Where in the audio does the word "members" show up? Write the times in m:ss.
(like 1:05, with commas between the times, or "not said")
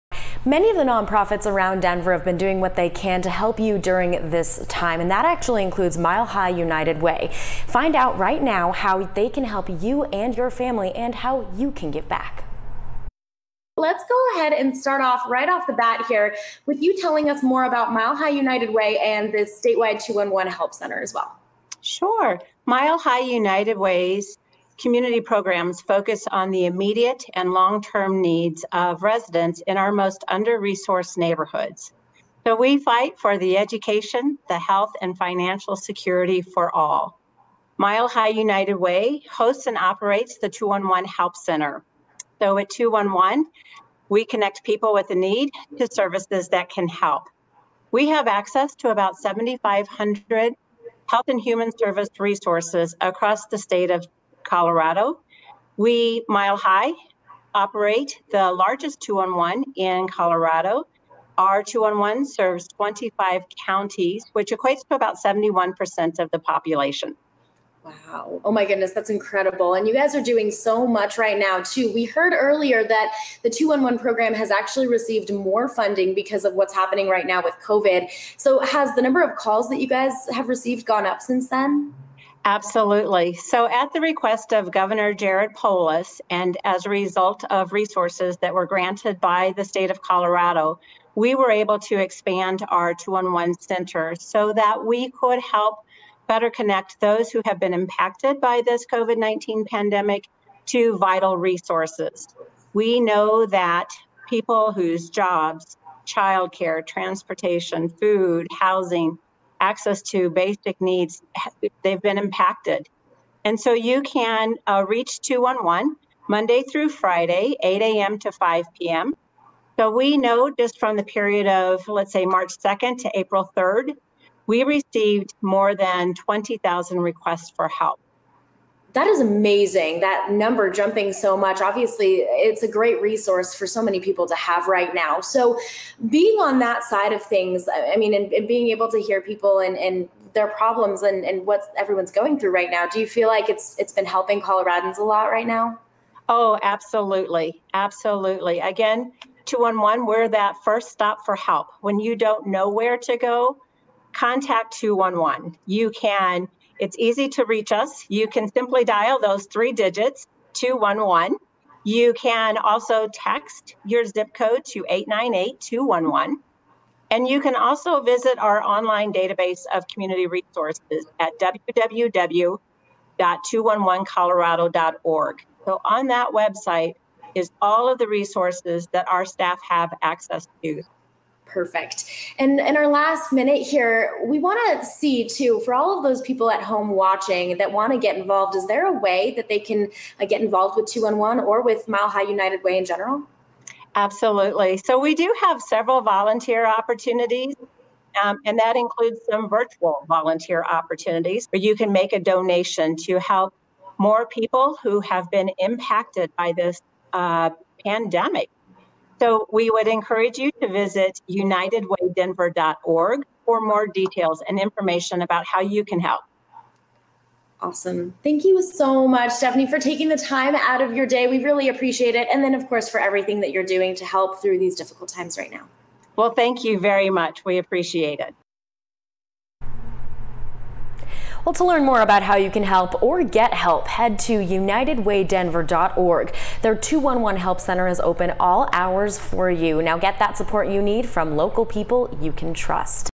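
not said.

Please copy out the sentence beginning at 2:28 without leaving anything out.
Again, 211, we're that first stop for help.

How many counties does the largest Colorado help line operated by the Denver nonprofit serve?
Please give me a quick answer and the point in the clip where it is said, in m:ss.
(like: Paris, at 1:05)
25, at 1:02.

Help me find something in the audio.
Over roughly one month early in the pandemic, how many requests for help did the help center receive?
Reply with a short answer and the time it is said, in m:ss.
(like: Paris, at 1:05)
more than 20,000, at 2:05.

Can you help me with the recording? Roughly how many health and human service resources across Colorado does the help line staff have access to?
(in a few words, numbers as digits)
7,500.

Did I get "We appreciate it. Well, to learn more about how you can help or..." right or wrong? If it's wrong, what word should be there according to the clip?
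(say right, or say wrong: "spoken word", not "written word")
right.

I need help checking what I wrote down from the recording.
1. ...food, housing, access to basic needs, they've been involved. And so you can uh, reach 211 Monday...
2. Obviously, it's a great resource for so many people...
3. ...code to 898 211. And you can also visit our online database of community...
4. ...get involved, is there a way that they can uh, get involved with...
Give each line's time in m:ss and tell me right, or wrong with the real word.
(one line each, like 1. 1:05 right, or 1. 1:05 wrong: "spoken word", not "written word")
1. 1:47 wrong: "impacted", not "involved"
2. 2:11 right
3. 2:44 right
4. 3:07 right.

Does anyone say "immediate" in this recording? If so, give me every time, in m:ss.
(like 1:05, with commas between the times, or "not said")
0:26.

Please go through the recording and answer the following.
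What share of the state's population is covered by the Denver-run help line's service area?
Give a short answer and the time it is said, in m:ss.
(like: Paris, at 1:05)
71%, at 1:05.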